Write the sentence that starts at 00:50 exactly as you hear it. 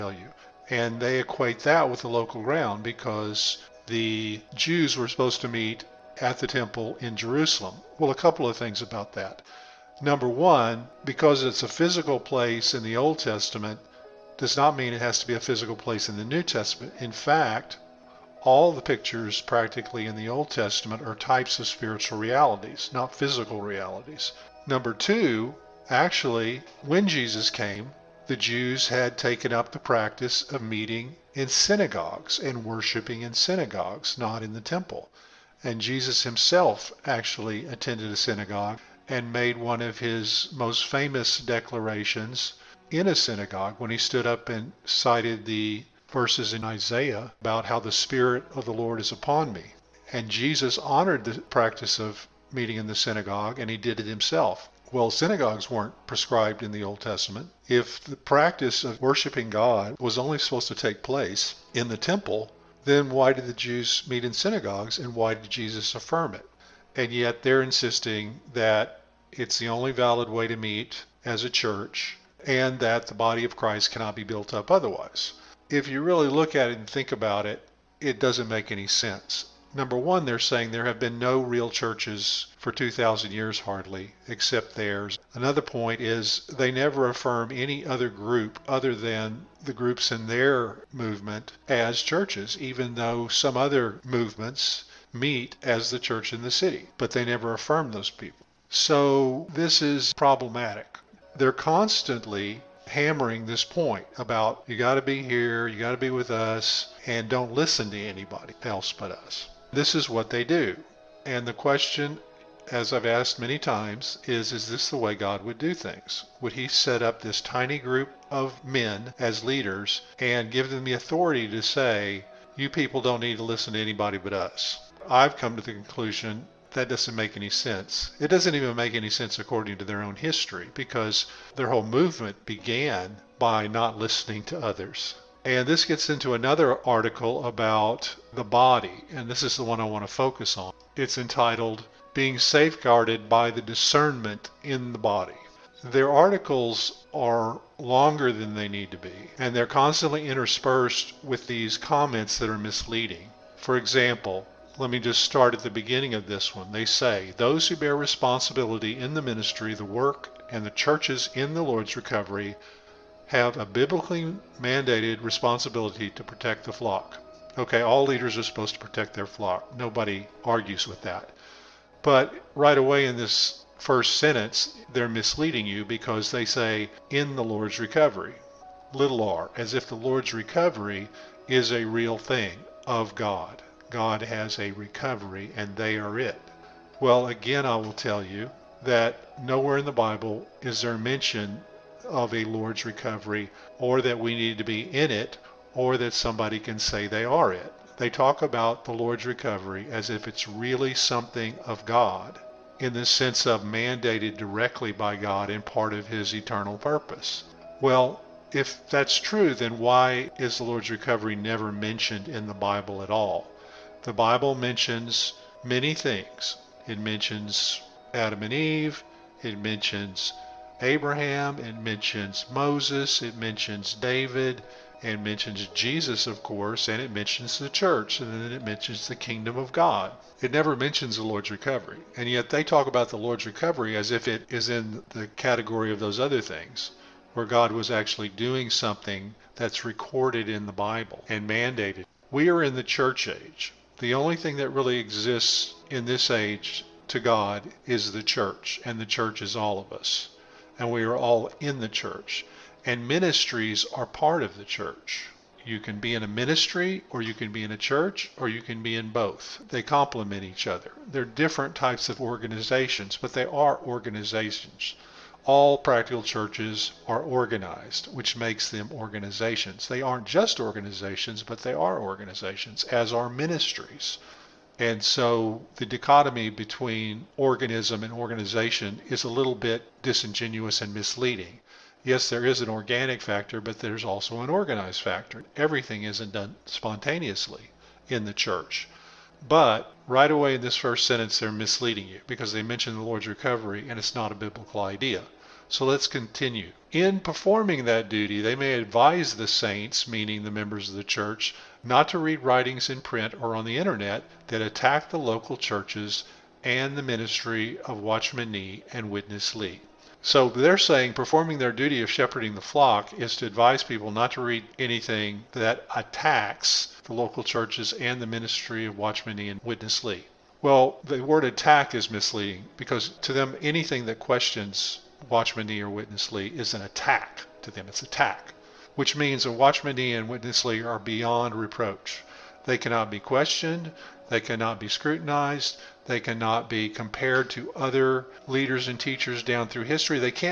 And Jesus honored the practice of meeting in the synagogue, and he did it himself.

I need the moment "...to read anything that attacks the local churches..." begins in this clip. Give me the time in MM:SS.
05:14.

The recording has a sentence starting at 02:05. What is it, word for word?
I've come to the conclusion that doesn't make any sense.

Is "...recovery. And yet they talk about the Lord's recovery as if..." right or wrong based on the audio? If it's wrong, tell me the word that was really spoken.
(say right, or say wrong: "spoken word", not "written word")
right.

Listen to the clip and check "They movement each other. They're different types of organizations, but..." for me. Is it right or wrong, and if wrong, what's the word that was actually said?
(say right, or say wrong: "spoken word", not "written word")
wrong: "complement", not "movement".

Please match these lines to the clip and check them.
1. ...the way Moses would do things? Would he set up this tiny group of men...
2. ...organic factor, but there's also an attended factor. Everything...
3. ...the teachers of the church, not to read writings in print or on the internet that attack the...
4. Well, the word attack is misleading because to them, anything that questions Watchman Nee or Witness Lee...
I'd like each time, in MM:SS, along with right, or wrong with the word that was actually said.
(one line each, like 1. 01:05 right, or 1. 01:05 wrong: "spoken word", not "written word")
1. 01:54 wrong: "God", not "Moses"
2. 04:42 wrong: "organized", not "attended"
3. 05:00 wrong: "members", not "teachers"
4. 05:20 right.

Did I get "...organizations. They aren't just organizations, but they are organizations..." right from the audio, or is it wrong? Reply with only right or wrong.
right.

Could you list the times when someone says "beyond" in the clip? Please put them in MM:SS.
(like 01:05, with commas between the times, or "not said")
05:30.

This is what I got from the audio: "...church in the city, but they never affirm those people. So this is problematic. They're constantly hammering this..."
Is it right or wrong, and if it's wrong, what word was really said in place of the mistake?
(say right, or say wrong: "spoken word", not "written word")
right.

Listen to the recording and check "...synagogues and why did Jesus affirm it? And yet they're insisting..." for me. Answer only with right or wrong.
right.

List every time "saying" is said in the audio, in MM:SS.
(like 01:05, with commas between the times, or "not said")
01:20, 05:10.